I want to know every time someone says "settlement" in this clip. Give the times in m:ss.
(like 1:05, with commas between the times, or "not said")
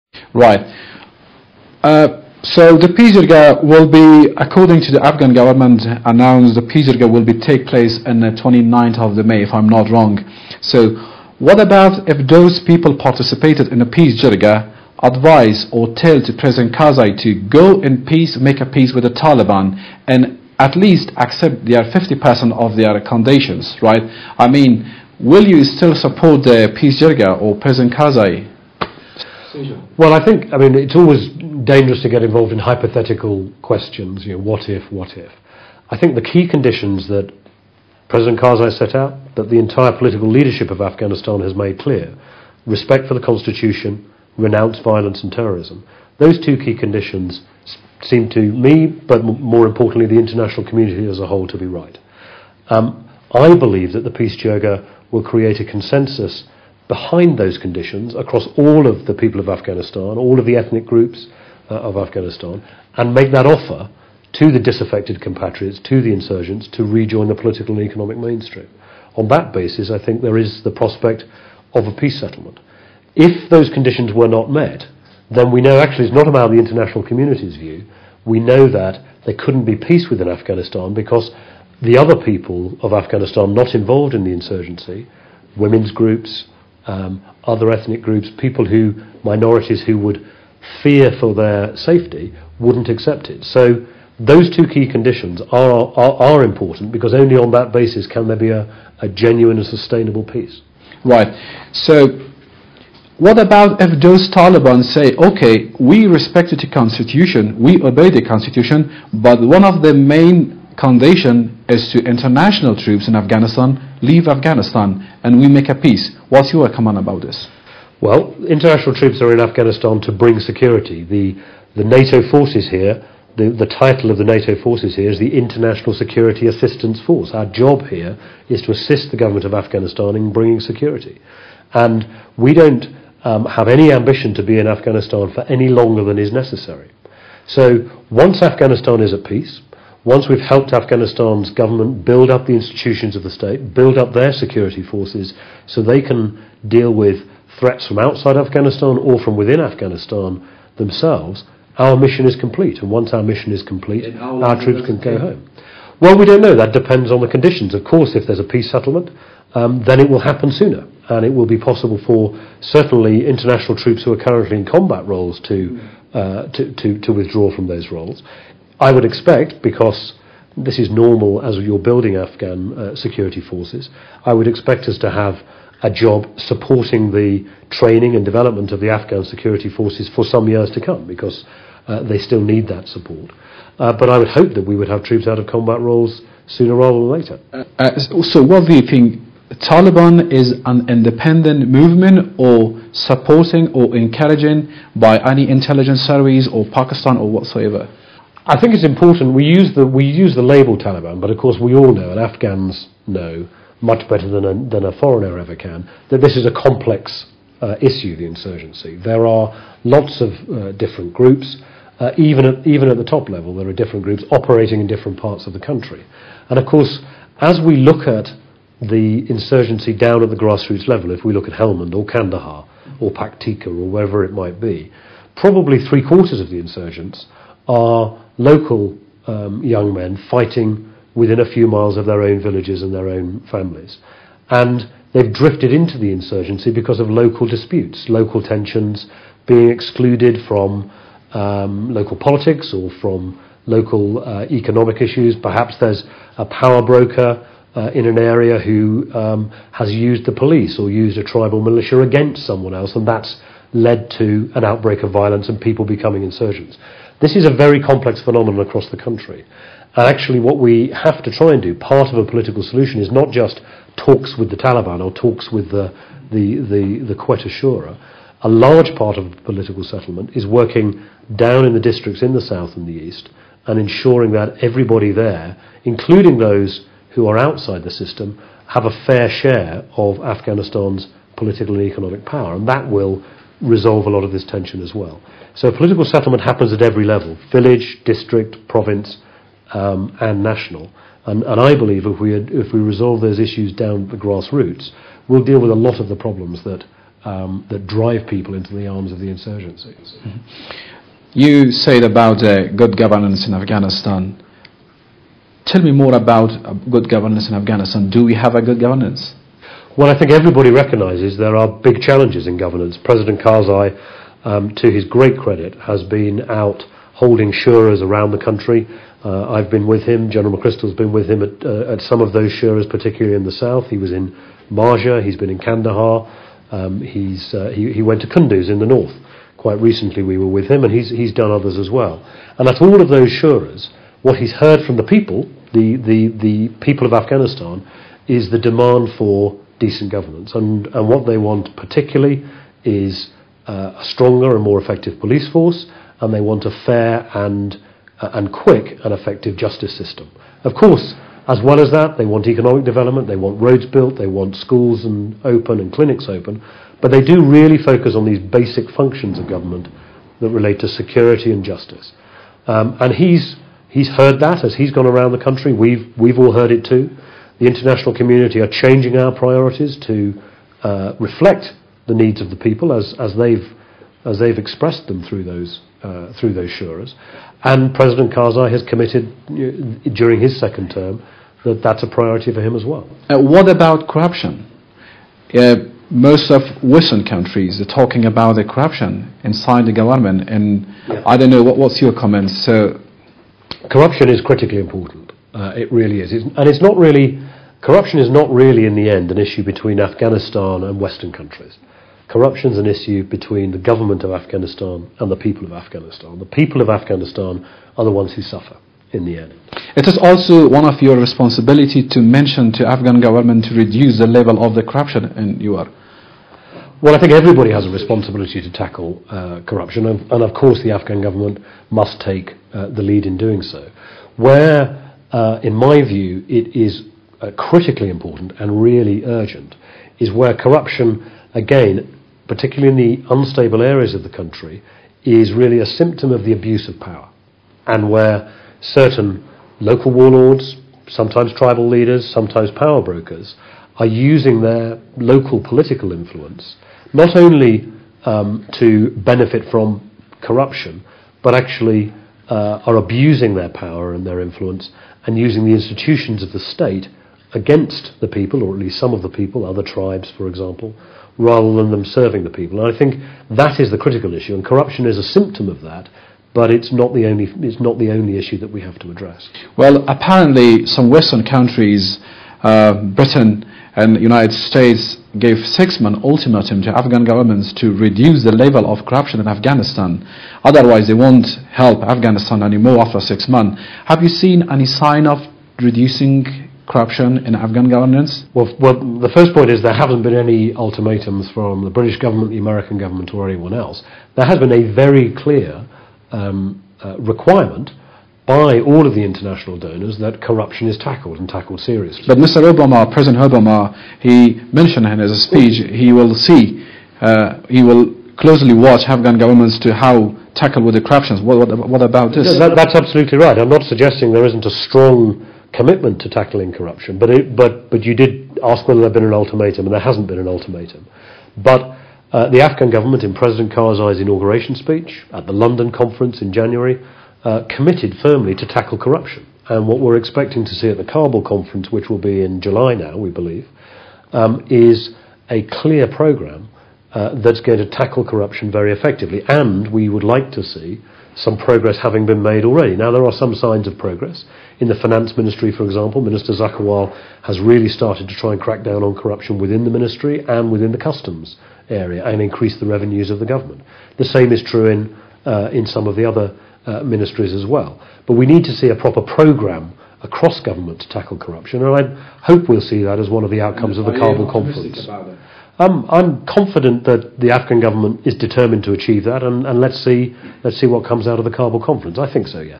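1:12, 2:38, 4:29, 4:46.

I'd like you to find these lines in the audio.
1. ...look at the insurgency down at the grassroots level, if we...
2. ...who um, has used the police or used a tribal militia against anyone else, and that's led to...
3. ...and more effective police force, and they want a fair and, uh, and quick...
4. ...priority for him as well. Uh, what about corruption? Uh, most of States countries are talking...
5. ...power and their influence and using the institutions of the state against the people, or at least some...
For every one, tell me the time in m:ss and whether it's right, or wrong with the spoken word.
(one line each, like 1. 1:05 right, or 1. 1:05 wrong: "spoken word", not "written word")
1. 3:37 right
2. 4:08 wrong: "someone", not "anyone"
3. 5:44 right
4. 6:22 wrong: "Western", not "States"
5. 7:33 right.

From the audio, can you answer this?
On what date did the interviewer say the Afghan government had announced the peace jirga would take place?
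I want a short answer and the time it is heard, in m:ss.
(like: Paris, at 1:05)
29 May, at 0:08.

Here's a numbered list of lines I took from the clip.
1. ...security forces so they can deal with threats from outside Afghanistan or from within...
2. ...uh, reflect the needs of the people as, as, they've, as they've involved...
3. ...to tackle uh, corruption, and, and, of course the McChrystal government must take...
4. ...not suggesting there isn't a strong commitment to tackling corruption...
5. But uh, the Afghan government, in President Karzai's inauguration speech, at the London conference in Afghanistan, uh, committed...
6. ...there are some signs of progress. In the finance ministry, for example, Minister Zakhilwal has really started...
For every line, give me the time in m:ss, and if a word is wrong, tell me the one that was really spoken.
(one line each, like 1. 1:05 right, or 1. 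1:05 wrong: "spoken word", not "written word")
1. 2:24 right
2. 6:10 wrong: "expressed", not "involved"
3. 6:58 wrong: "Afghan", not "McChrystal"
4. 8:33 right
5. 8:41 wrong: "January", not "Afghanistan"
6. 9:03 right.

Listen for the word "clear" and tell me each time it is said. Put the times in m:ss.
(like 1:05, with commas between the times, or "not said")
0:41, 8:15, 8:55.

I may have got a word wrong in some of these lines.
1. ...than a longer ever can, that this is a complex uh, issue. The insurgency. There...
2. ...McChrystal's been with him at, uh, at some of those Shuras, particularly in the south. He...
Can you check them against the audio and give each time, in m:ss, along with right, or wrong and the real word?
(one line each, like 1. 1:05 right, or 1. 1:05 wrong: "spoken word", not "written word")
1. 3:24 wrong: "foreigner", not "longer"
2. 5:20 right.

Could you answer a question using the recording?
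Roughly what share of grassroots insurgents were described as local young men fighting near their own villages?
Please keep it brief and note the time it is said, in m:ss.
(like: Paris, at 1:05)
three quarters, at 3:45.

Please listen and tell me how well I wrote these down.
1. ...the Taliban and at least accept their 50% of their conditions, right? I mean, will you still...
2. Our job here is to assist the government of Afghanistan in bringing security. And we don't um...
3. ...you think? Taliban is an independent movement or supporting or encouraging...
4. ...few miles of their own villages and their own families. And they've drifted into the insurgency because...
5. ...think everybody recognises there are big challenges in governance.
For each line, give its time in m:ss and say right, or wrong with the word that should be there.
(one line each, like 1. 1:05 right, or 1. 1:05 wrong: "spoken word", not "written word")
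1. 0:19 right
2. 2:07 right
3. 3:08 right
4. 3:51 right
5. 5:10 right.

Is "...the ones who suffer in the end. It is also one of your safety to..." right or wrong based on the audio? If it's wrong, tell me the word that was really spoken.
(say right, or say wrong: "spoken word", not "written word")
wrong: "responsibility", not "safety".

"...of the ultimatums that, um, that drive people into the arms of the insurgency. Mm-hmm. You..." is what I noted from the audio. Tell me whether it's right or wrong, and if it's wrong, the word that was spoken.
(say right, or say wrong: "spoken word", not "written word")
wrong: "problems", not "ultimatums".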